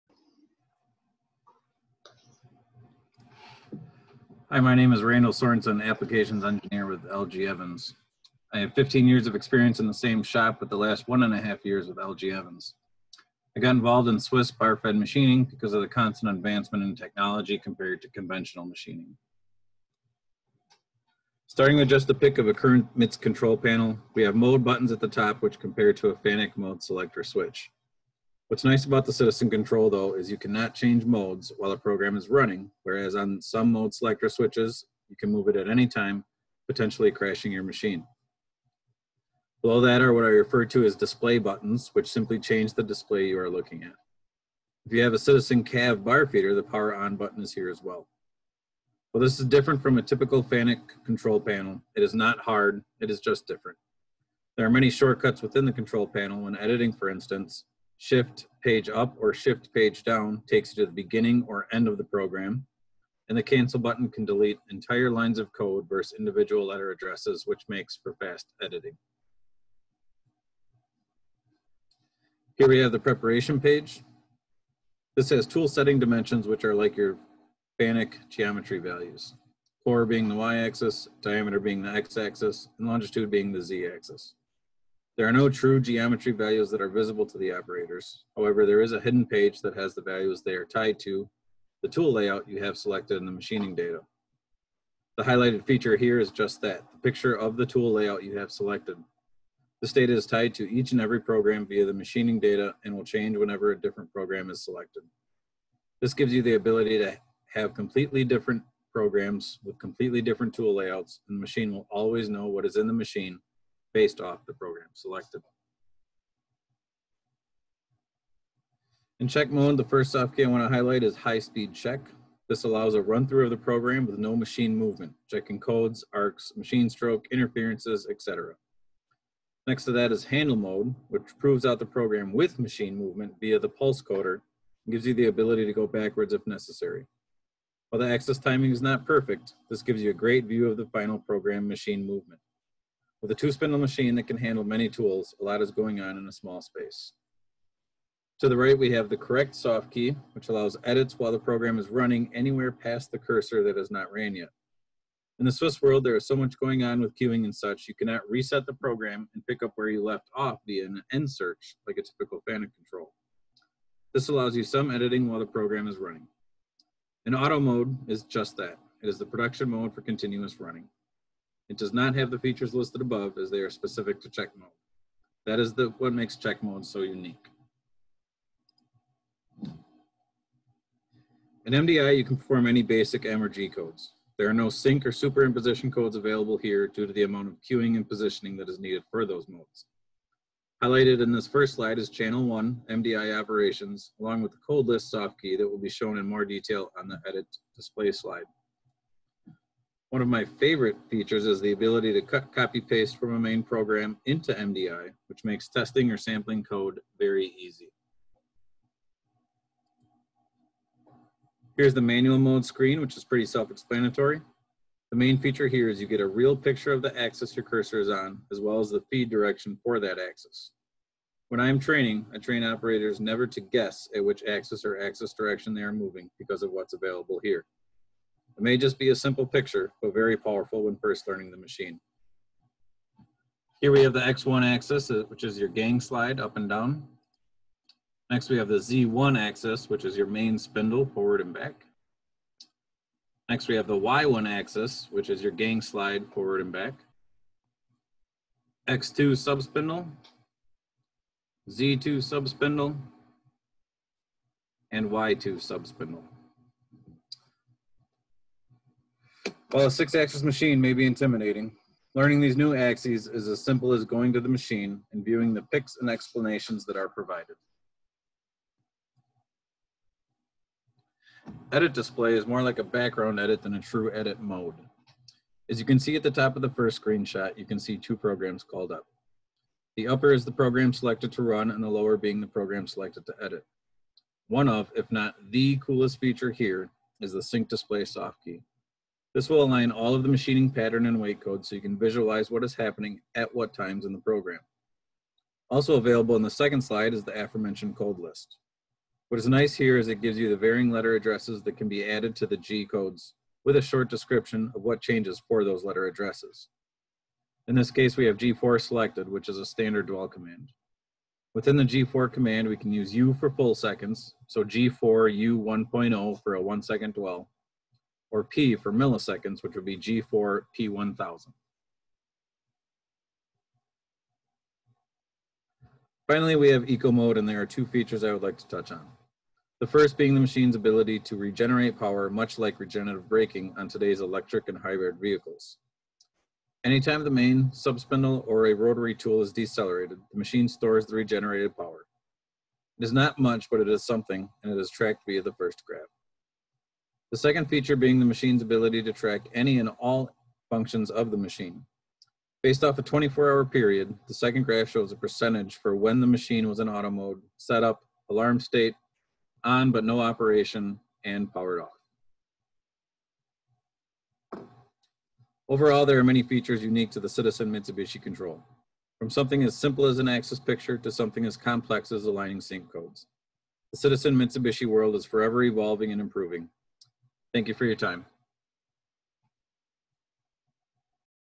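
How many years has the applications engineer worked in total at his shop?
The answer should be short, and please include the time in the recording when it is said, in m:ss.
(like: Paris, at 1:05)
15 years, at 0:08.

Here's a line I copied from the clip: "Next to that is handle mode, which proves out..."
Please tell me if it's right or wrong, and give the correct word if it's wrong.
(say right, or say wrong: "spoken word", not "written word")
right.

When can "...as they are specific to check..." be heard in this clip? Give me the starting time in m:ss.
2:53.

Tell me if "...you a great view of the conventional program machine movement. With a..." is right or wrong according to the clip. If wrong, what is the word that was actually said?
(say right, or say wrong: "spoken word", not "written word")
wrong: "final", not "conventional".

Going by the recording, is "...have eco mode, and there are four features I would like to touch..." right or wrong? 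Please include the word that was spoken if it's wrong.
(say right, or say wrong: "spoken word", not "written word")
wrong: "two", not "four".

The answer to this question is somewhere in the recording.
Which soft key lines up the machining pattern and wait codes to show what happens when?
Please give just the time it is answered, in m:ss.
4:47.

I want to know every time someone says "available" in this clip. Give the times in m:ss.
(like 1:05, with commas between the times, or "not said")
3:06, 3:46, 4:55.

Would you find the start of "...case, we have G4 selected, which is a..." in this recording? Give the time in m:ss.
5:07.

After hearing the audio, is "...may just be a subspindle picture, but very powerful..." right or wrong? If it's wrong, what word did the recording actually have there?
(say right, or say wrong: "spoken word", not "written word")
wrong: "simple", not "subspindle".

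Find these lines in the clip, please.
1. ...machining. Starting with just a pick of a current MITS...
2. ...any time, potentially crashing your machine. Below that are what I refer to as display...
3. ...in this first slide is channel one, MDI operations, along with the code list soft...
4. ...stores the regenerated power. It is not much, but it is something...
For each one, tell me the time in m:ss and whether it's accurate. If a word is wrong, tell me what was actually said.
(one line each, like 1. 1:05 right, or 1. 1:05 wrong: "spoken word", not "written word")
1. 0:18 right
2. 0:35 right
3. 3:11 right
4. 5:40 right.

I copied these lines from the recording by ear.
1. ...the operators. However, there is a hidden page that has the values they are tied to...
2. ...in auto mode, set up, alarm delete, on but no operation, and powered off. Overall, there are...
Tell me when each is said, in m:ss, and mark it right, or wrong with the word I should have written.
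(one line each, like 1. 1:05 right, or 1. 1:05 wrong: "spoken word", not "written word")
1. 1:27 right
2. 5:56 wrong: "state", not "delete".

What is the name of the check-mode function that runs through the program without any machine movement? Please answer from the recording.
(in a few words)
high-speed check.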